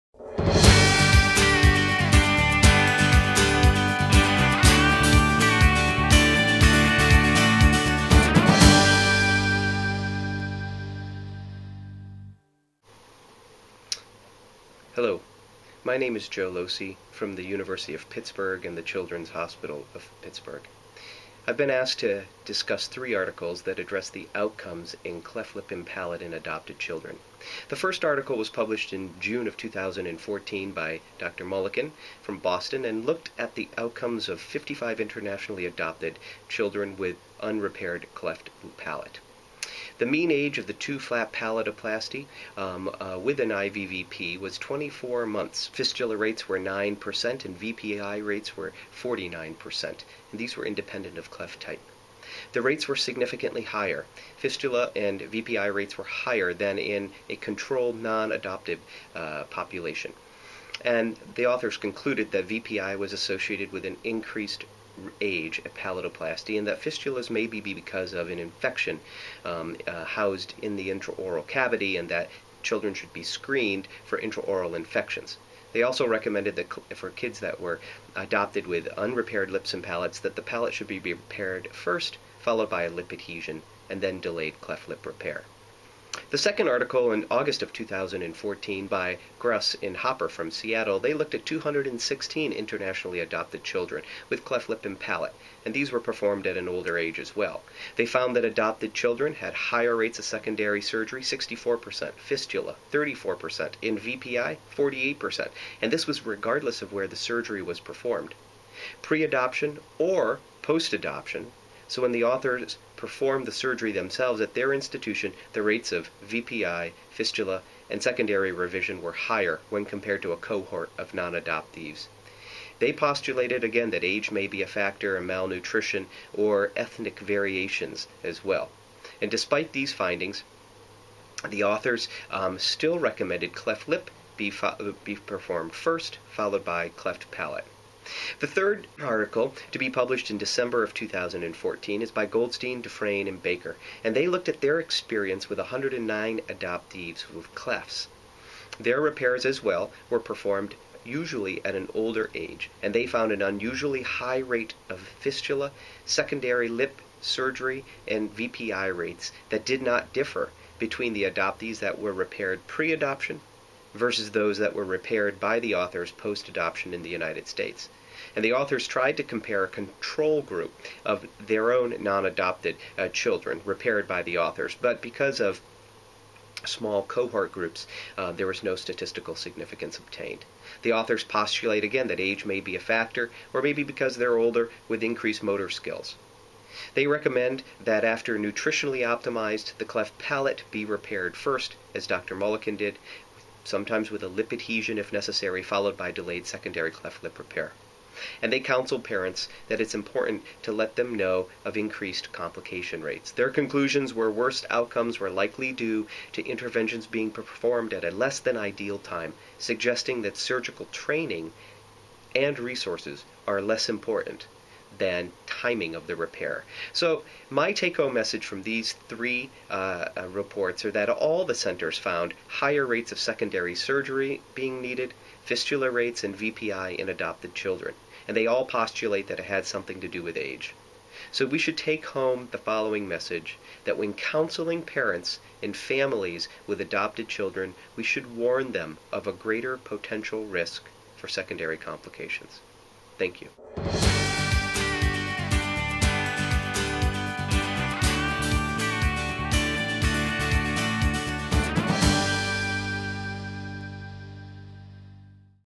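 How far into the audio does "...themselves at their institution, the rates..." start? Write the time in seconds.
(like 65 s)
113 s.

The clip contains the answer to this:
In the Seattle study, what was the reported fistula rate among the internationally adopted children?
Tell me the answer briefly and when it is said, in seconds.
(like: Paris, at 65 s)
34%, at 102 s.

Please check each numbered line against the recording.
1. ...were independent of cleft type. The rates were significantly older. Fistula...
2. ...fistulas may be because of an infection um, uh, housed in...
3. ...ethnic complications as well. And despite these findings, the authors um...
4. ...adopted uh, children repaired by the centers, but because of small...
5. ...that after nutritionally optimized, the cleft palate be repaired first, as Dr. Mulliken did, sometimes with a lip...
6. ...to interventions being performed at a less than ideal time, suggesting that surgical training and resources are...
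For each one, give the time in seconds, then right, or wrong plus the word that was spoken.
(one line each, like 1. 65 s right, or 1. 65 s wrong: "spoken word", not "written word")
1. 50 s wrong: "higher", not "older"
2. 66 s right
3. 126 s wrong: "variations", not "complications"
4. 172 s wrong: "authors", not "centers"
5. 187 s right
6. 206 s right.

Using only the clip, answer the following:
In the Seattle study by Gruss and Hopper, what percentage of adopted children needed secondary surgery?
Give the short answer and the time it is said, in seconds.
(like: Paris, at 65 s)
64%, at 101 s.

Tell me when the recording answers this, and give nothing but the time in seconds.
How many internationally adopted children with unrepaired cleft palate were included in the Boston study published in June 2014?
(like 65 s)
34 s.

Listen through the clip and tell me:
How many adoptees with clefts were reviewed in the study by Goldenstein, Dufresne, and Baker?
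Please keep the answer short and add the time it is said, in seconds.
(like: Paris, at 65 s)
109, at 145 s.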